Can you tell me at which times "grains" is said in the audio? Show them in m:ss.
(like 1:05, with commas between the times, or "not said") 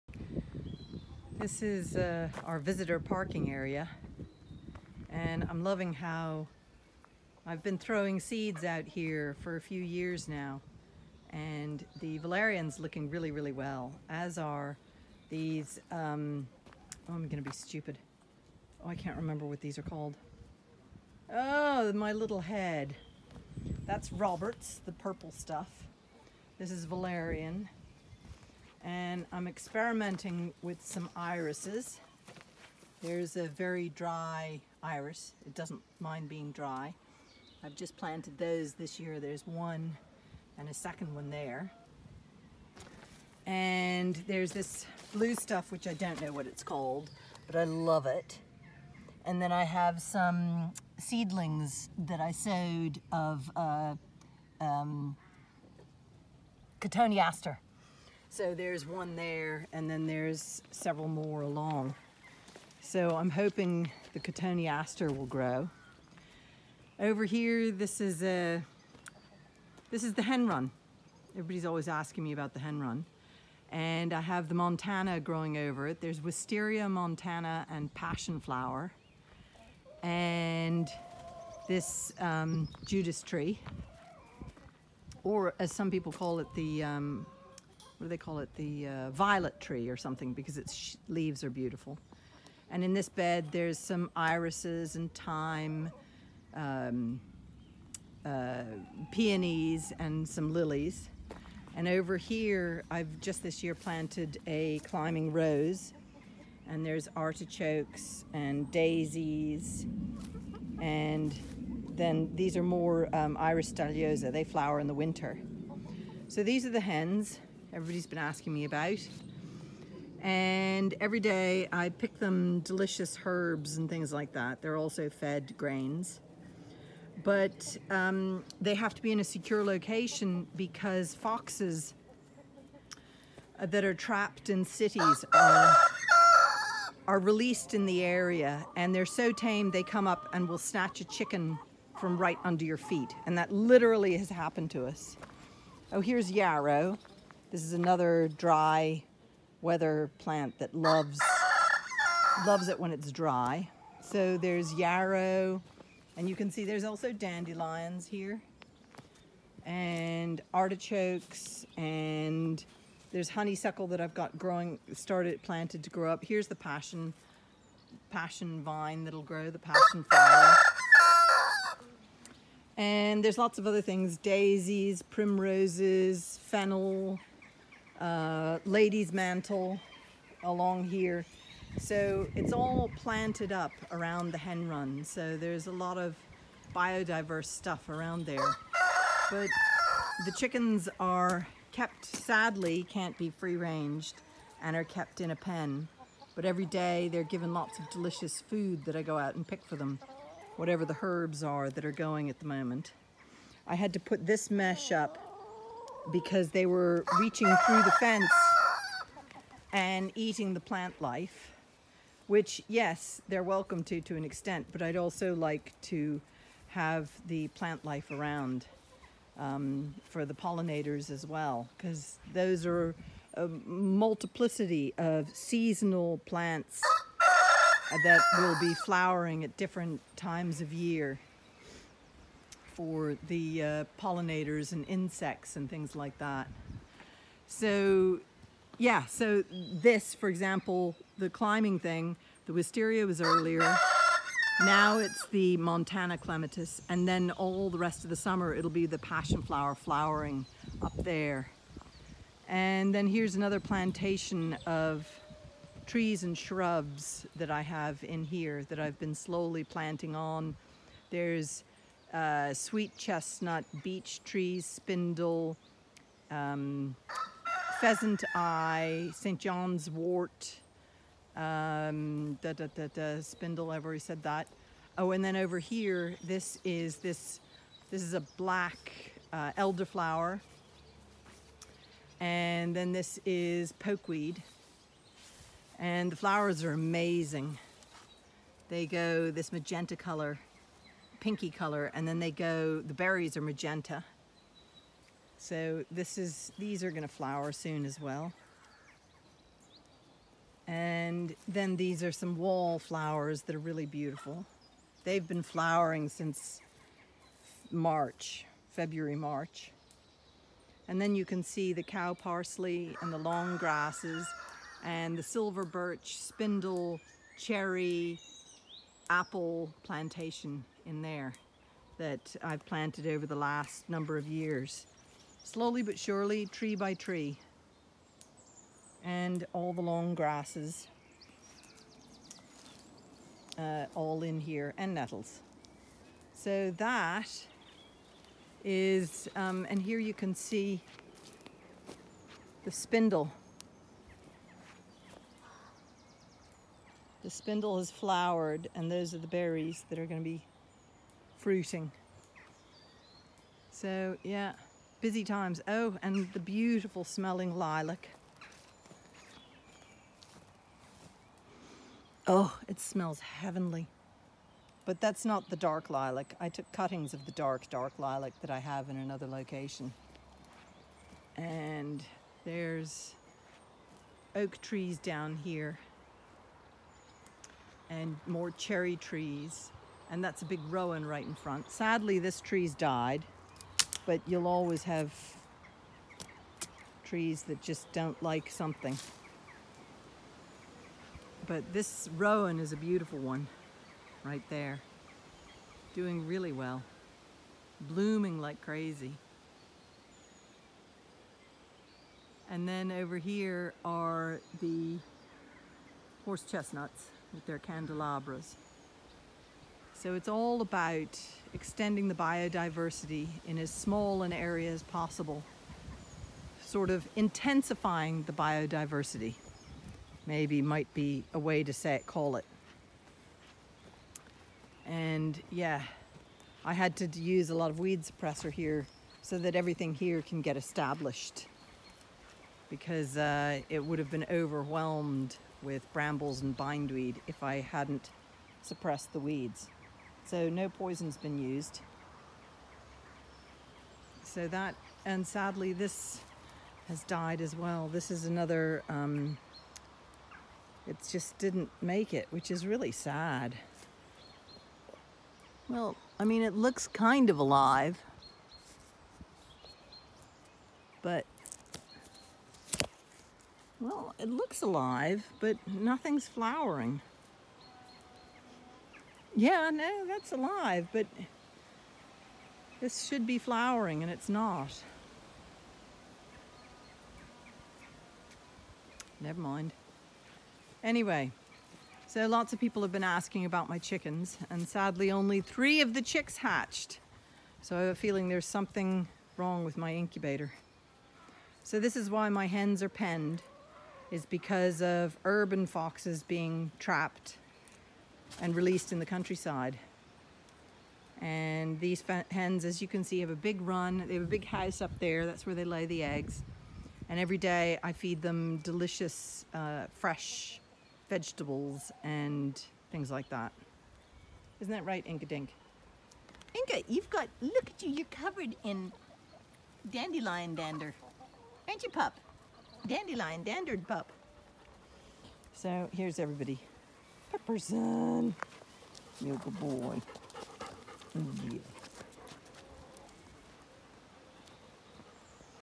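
2:05.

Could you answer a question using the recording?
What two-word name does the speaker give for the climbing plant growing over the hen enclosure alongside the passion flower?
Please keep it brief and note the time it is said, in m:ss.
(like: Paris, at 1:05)
Wisteria Montana, at 1:16.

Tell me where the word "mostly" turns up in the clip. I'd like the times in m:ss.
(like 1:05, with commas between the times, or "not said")
not said.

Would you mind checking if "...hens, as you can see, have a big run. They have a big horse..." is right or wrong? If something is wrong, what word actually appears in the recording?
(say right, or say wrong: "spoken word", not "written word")
wrong: "house", not "horse".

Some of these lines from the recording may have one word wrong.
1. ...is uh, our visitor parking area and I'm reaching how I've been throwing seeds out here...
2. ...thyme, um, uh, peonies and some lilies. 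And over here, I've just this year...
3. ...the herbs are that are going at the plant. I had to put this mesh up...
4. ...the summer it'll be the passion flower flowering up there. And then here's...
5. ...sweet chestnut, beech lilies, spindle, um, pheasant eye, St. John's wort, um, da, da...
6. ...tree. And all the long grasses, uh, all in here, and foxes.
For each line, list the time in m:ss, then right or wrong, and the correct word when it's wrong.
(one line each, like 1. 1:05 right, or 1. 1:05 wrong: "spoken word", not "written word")
1. 0:01 wrong: "loving", not "reaching"
2. 1:35 right
3. 3:20 wrong: "moment", not "plant"
4. 4:08 right
5. 4:22 wrong: "trees", not "lilies"
6. 5:26 wrong: "nettles", not "foxes".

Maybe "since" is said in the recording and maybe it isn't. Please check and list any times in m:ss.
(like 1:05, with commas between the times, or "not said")
5:06.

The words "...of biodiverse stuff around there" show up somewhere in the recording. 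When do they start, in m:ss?
3:05.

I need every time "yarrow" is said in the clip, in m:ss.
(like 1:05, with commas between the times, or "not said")
2:26, 2:34.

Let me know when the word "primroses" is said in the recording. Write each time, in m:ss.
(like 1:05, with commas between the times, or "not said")
2:55.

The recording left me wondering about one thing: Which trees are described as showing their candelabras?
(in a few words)
Horse chestnuts.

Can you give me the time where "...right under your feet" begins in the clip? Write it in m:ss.
2:22.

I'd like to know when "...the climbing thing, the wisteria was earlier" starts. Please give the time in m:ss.
4:01.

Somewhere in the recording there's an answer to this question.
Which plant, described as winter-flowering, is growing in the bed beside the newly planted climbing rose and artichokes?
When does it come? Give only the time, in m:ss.
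1:53.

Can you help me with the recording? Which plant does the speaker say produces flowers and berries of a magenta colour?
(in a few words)
Pokeweed.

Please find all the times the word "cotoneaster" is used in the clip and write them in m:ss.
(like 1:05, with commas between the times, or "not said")
0:56, 1:04.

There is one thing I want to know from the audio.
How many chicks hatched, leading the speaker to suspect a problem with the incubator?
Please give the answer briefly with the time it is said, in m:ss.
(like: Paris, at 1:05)
3, at 8:05.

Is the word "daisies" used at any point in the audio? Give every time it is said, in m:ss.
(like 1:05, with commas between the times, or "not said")
1:48, 2:54.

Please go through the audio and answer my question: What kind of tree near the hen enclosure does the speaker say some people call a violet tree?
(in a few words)
Judas tree.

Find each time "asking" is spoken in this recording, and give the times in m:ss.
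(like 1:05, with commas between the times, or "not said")
1:11, 1:58, 8:03.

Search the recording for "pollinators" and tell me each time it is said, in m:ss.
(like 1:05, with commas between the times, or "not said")
3:40, 3:54.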